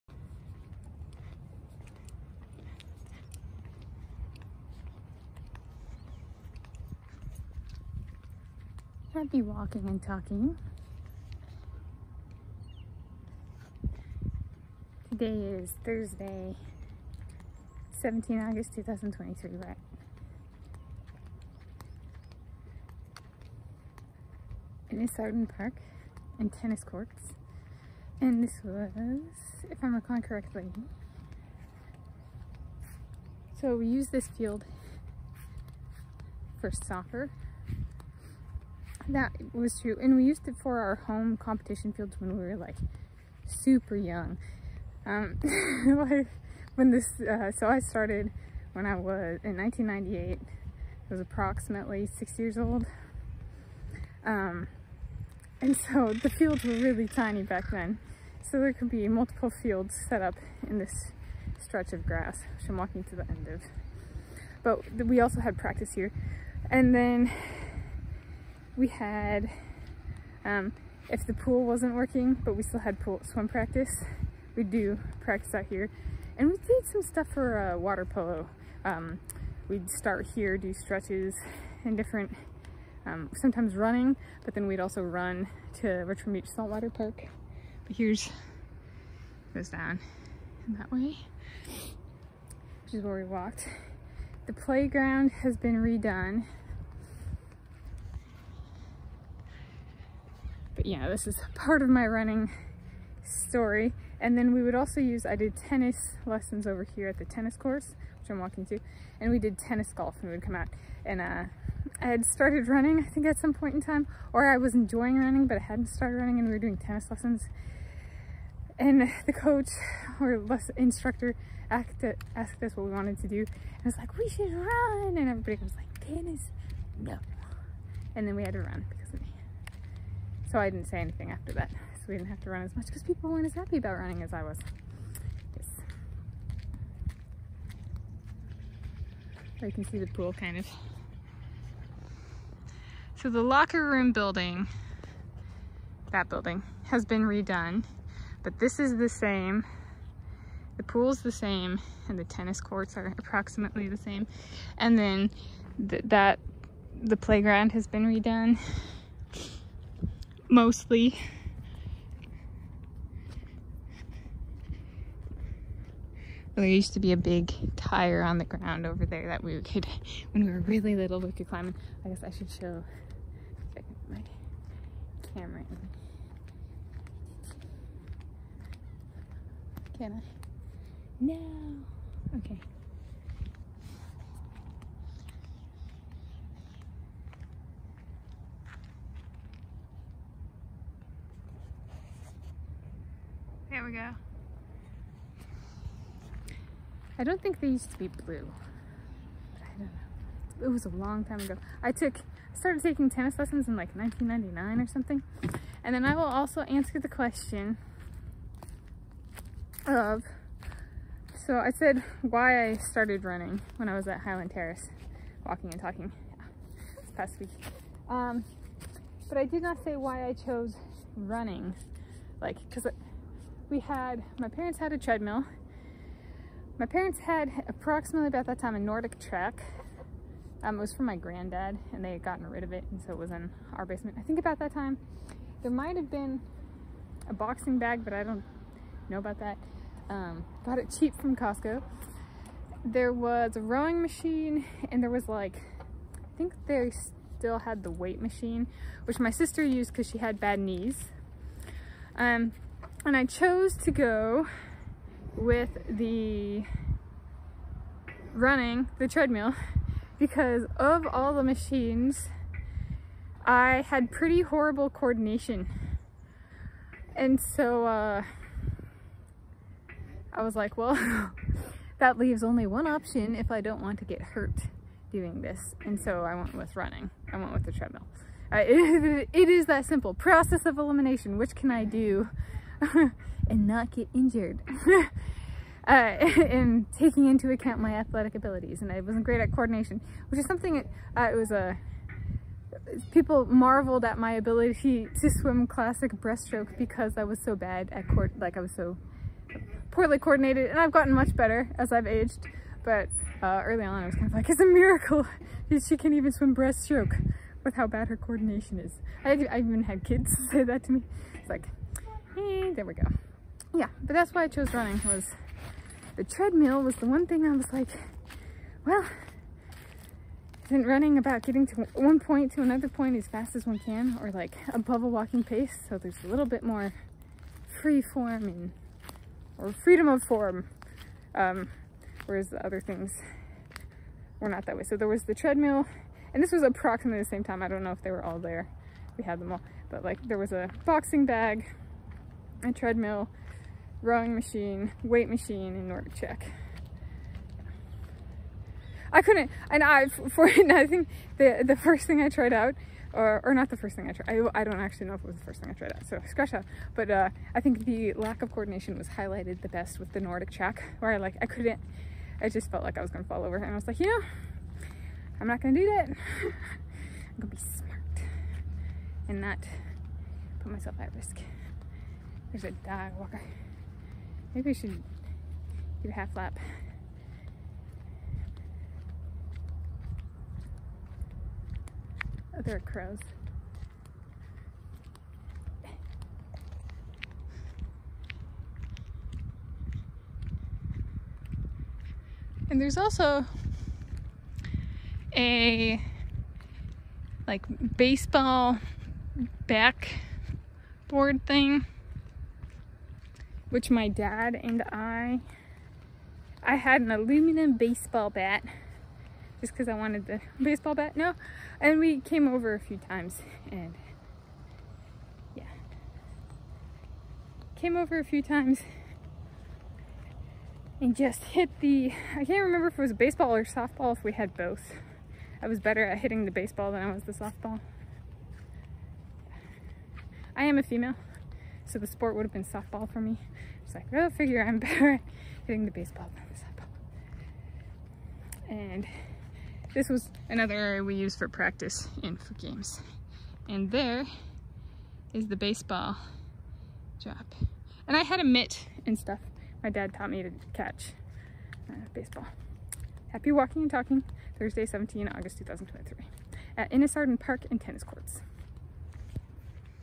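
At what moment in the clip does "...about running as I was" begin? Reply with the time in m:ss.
2:13.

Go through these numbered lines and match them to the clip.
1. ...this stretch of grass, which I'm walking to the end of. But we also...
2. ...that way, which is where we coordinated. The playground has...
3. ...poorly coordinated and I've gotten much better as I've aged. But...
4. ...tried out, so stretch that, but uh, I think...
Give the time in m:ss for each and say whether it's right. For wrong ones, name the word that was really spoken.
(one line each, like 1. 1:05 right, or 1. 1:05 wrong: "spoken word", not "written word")
1. 1:00 right
2. 1:30 wrong: "walked", not "coordinated"
3. 4:59 right
4. 5:55 wrong: "scratch", not "stretch".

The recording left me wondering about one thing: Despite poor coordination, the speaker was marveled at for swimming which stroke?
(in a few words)
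Classic breaststroke.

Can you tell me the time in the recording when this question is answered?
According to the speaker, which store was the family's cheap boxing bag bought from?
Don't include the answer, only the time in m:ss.
4:01.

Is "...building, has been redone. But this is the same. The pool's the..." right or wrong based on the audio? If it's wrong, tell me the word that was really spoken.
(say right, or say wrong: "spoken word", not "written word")
right.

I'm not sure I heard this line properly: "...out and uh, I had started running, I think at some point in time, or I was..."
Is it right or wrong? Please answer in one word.
right.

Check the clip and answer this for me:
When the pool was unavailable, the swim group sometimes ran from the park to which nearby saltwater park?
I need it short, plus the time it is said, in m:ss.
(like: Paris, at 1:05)
Richmond Beach Saltwater Park, at 1:25.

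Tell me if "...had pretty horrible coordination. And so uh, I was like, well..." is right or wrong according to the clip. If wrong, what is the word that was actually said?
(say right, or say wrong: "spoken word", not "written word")
right.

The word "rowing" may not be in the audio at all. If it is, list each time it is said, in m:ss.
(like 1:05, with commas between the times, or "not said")
4:03, 5:44.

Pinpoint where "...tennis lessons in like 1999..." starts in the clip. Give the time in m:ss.
3:23.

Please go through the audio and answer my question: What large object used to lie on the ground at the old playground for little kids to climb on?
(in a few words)
A big tire.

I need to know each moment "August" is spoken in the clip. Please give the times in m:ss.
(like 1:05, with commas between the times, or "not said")
0:18, 7:35.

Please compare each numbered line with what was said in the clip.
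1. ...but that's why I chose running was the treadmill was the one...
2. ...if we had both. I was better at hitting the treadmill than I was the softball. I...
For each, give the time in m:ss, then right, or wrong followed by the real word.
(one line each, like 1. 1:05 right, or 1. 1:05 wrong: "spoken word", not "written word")
1. 5:14 right
2. 7:04 wrong: "baseball", not "treadmill".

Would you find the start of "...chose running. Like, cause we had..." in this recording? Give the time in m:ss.
3:40.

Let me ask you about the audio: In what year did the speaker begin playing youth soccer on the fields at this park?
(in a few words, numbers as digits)
1998.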